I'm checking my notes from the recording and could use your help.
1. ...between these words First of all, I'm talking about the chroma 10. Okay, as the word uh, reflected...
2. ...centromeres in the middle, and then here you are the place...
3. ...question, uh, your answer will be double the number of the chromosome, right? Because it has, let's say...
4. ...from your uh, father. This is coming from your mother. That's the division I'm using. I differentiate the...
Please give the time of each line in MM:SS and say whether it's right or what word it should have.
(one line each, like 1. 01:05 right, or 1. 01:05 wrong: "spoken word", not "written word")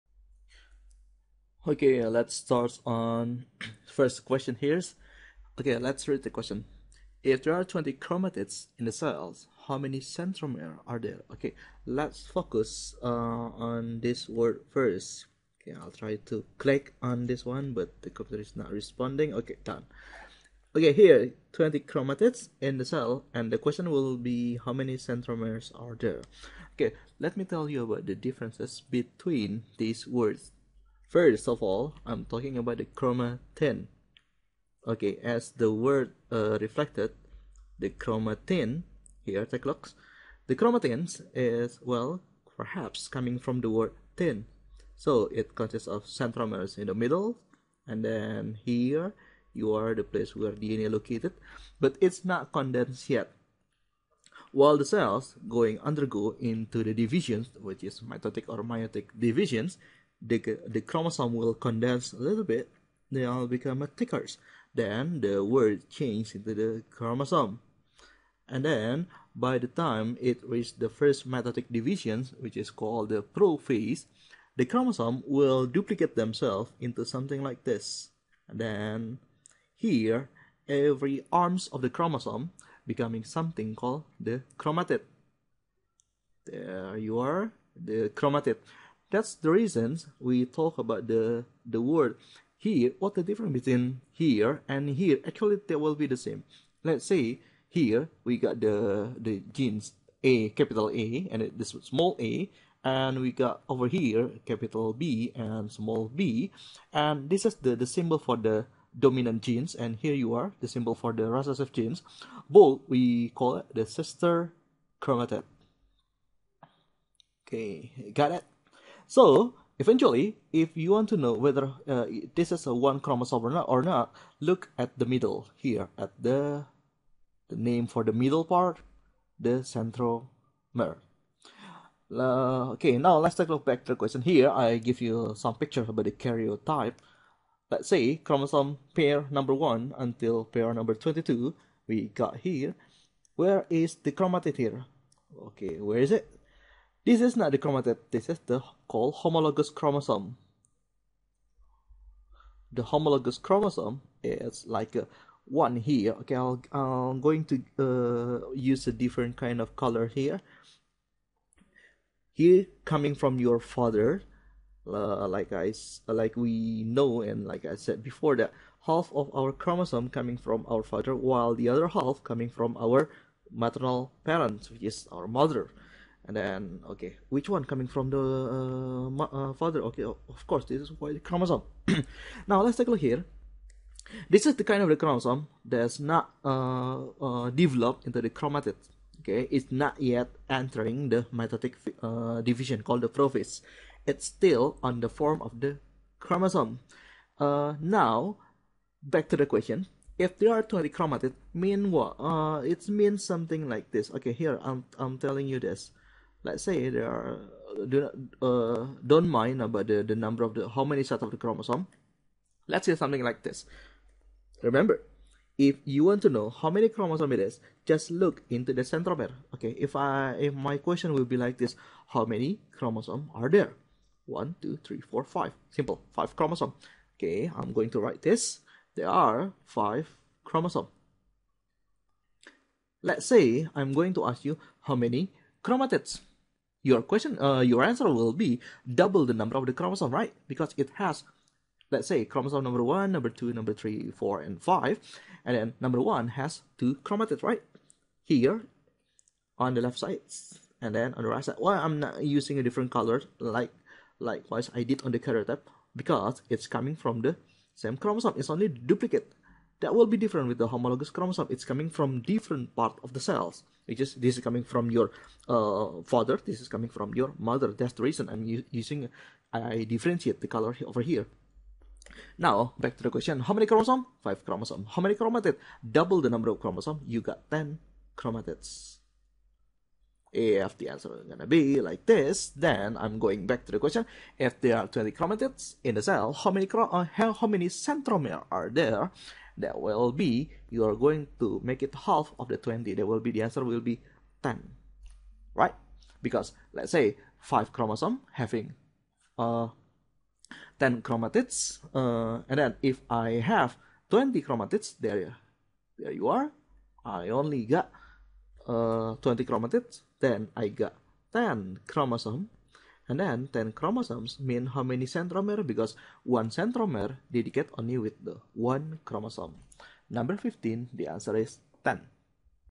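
1. 00:28 right
2. 00:46 right
3. 03:57 right
4. 04:24 wrong: "reason", not "division".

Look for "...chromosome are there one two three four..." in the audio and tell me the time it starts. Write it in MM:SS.
03:42.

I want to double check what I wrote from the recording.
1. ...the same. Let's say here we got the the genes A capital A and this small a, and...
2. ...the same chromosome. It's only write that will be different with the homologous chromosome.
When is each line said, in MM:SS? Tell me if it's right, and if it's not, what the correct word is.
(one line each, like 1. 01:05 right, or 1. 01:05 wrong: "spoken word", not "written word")
1. 01:36 right
2. 04:17 wrong: "duplicate", not "write".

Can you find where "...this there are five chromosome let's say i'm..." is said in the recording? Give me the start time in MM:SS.
03:48.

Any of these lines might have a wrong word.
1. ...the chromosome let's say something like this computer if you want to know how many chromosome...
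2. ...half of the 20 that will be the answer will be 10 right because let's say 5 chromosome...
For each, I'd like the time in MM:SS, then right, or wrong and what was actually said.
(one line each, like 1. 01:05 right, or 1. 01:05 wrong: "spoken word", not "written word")
1. 03:31 wrong: "remember", not "computer"
2. 04:51 right.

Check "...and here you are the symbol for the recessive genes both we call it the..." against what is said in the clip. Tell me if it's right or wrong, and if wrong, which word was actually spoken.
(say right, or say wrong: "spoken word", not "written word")
right.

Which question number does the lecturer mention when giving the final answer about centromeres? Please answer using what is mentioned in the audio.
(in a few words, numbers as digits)
15.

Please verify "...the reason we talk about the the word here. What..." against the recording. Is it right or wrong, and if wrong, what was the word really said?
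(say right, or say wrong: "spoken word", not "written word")
right.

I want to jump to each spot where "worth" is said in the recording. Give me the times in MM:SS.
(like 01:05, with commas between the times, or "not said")
not said.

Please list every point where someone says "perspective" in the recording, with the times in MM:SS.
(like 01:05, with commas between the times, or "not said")
not said.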